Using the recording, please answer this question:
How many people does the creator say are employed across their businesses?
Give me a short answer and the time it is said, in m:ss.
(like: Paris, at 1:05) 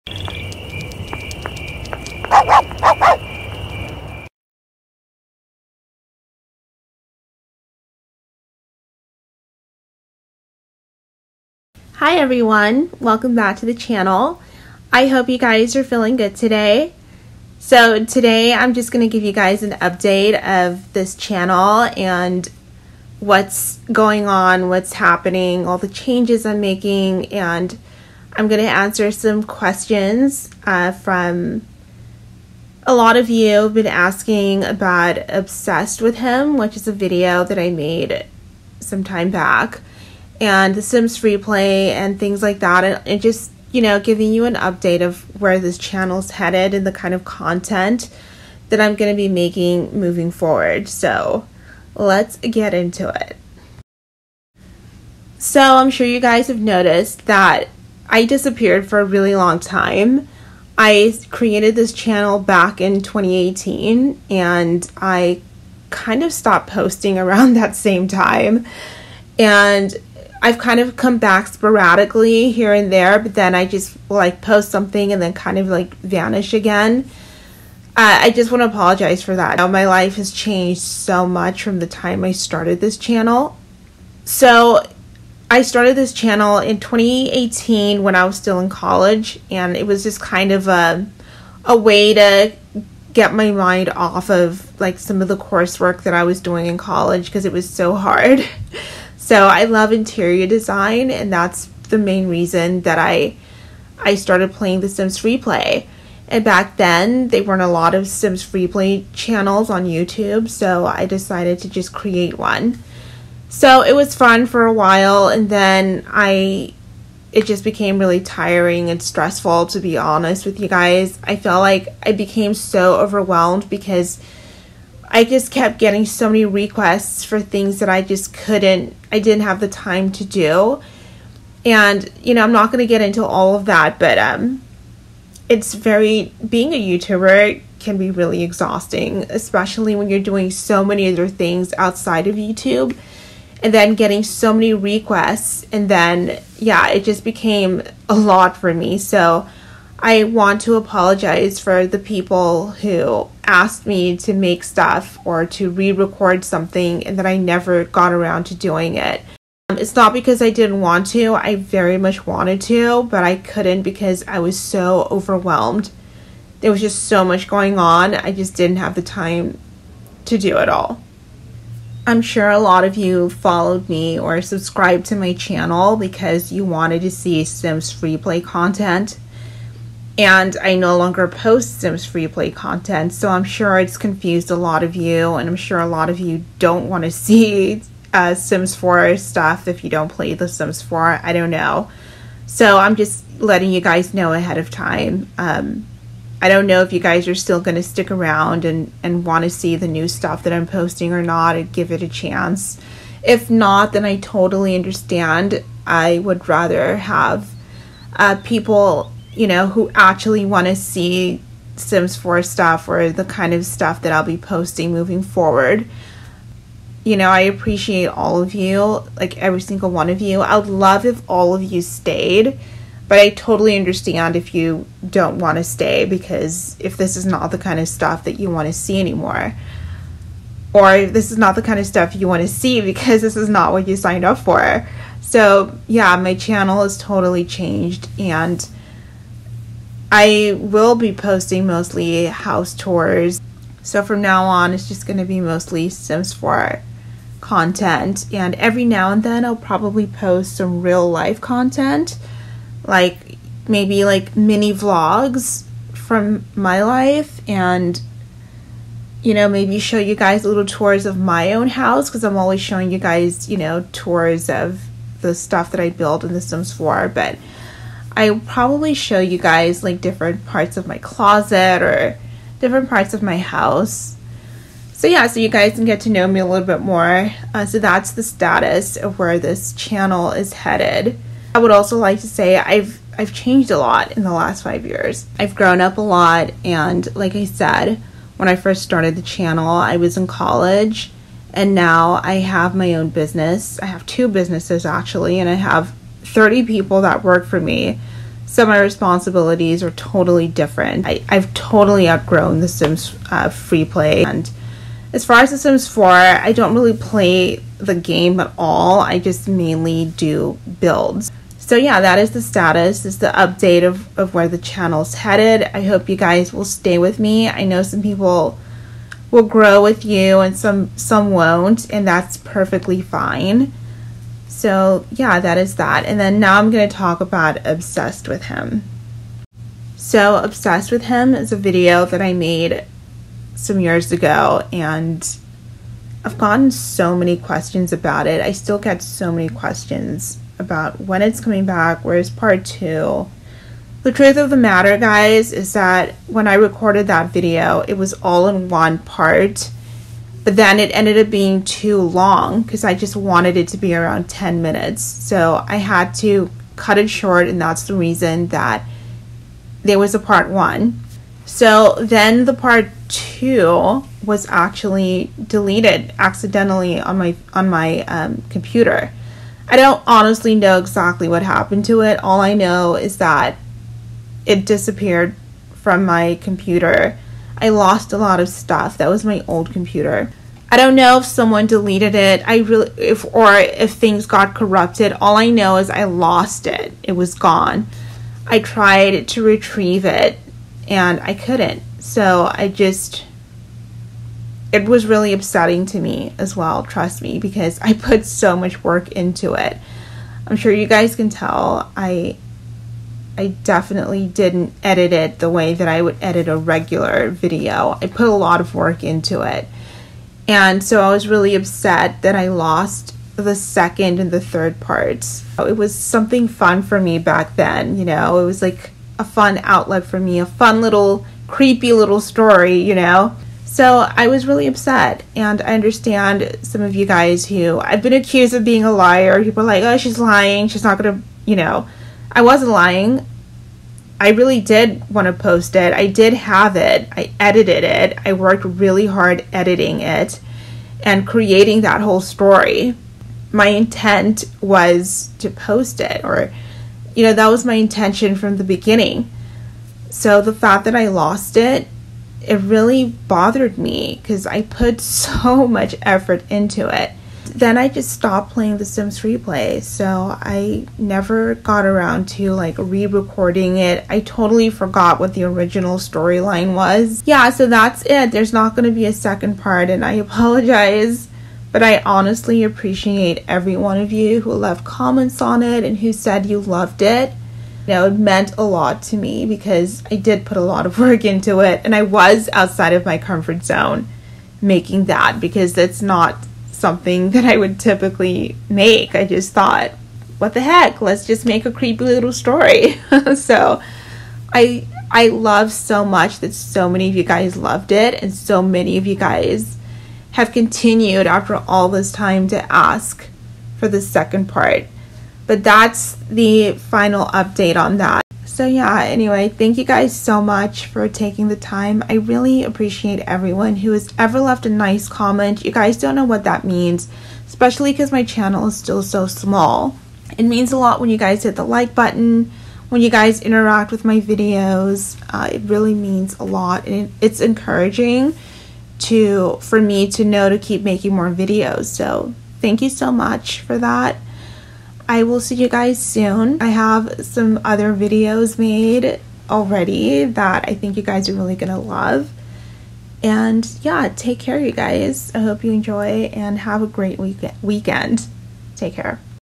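30, at 4:56.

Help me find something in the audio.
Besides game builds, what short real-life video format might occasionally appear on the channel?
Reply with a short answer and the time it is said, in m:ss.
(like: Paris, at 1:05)
mini vlogs, at 4:14.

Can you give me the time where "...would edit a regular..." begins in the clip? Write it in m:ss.
6:46.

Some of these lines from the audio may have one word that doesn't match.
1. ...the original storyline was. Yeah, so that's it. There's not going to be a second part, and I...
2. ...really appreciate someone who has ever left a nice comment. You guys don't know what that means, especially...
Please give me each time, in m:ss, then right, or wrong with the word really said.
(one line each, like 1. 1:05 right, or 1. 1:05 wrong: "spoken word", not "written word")
1. 7:45 right
2. 8:32 wrong: "everyone", not "someone".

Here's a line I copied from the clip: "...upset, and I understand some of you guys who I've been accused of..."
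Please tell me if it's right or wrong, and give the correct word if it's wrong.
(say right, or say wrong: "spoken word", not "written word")
right.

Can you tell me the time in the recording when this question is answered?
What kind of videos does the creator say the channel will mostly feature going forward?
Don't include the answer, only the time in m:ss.
4:02.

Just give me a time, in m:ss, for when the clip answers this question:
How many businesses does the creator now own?
4:54.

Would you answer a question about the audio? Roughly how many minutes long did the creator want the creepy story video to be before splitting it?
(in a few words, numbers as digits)
10.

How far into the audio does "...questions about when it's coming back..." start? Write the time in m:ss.
5:39.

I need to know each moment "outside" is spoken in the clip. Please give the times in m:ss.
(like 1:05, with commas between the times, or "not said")
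2:21, 8:02.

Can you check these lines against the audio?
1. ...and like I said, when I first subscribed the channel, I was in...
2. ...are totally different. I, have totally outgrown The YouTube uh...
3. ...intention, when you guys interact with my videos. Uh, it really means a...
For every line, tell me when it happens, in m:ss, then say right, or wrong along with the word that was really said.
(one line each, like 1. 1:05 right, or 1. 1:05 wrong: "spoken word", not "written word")
1. 4:46 wrong: "started", not "subscribed"
2. 4:59 wrong: "Sims", not "YouTube"
3. 8:41 wrong: "button", not "intention".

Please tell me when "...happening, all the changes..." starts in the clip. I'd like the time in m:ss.
0:24.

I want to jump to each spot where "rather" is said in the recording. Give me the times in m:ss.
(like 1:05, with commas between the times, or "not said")
3:26.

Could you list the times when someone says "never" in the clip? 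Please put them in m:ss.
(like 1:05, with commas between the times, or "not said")
2:37, 7:40.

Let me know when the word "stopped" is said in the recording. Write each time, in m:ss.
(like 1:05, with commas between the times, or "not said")
1:06, 7:38.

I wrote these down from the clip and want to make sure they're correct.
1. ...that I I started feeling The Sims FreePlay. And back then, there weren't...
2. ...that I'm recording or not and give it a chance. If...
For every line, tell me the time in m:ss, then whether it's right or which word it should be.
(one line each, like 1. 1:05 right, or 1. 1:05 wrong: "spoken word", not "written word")
1. 1:42 wrong: "playing", not "feeling"
2. 3:20 wrong: "posting", not "recording".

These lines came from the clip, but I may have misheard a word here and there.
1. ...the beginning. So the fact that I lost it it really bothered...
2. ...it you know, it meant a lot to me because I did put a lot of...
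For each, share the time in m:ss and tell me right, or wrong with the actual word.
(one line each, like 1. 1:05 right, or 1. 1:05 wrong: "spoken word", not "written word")
1. 7:28 right
2. 7:57 right.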